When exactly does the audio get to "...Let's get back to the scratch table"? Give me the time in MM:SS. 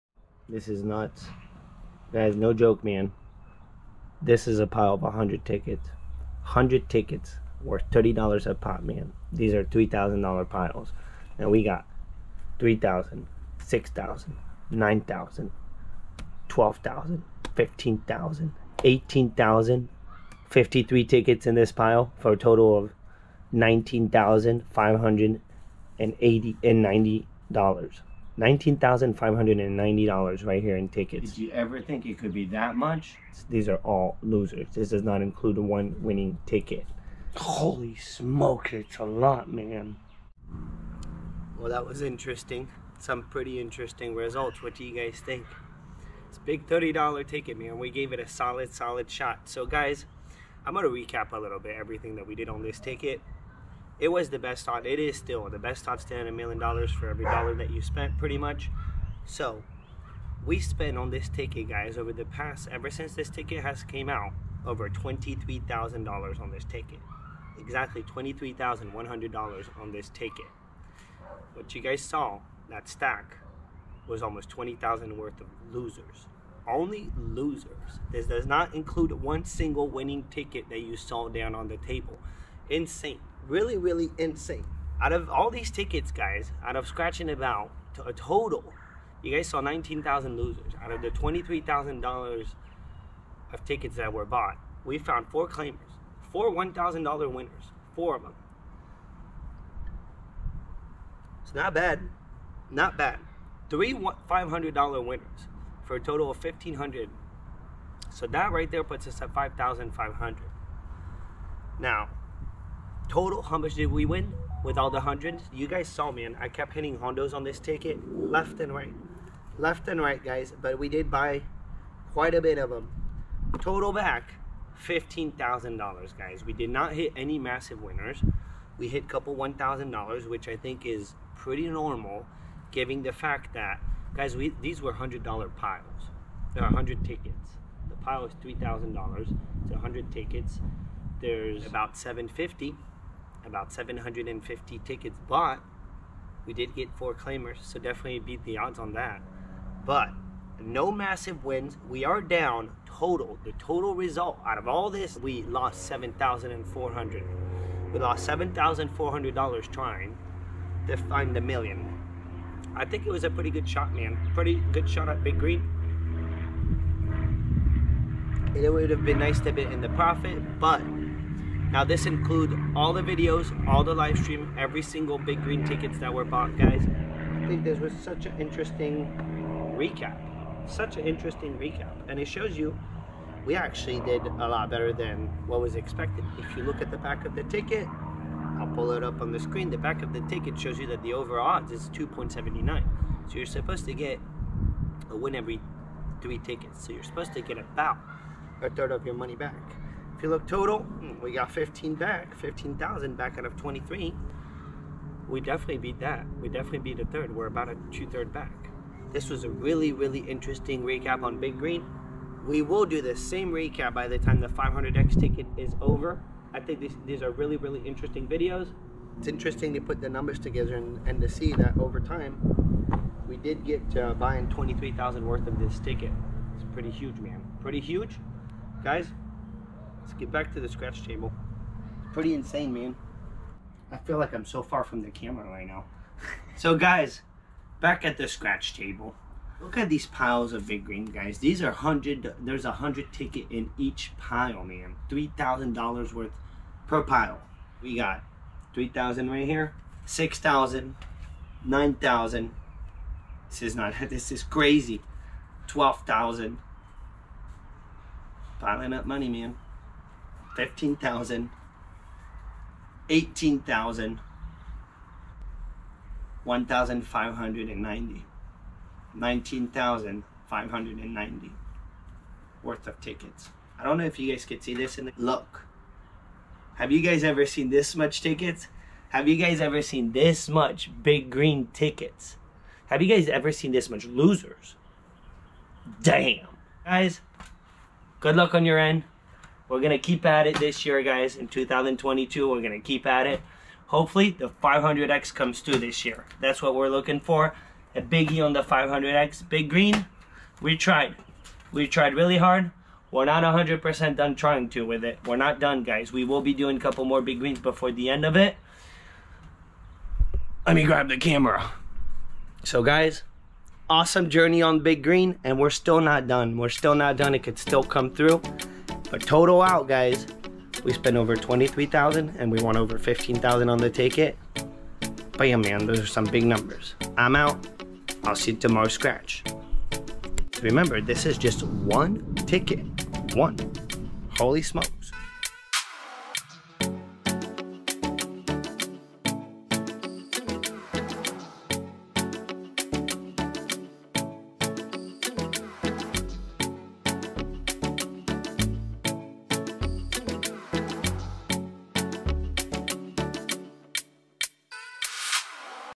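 03:50.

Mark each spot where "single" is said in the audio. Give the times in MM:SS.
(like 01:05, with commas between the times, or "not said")
01:19, 02:54.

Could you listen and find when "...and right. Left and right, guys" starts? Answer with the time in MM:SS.
01:58.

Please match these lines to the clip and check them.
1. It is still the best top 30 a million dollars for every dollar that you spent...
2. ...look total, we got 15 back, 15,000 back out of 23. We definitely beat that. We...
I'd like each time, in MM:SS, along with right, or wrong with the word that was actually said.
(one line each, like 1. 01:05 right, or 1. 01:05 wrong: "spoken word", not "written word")
1. 00:54 wrong: "10", not "30"
2. 03:20 right.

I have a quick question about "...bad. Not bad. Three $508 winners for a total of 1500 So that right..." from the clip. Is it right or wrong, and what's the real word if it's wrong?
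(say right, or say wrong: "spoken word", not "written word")
wrong: "500", not "508".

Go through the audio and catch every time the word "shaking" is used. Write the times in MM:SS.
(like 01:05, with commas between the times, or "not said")
not said.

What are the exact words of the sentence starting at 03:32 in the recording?
We will do the same recap by the time the 500X ticket is over.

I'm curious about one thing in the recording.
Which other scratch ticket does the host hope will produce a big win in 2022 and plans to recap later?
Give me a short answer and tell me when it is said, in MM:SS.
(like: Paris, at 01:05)
500X, at 04:54.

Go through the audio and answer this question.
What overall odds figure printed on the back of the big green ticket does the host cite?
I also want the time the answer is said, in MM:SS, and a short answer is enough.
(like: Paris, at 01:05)
2.79, at 03:11.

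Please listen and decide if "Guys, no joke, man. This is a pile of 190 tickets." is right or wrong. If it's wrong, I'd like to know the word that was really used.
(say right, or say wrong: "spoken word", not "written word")
wrong: "100", not "190".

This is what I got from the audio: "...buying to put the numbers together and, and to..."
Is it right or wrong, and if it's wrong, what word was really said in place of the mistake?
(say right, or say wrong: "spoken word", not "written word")
wrong: "interesting", not "buying".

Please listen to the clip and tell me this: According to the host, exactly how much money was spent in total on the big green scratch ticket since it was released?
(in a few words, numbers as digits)
$23,100.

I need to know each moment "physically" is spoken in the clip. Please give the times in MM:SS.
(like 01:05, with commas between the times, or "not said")
not said.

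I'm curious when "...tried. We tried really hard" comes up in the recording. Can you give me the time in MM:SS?
05:00.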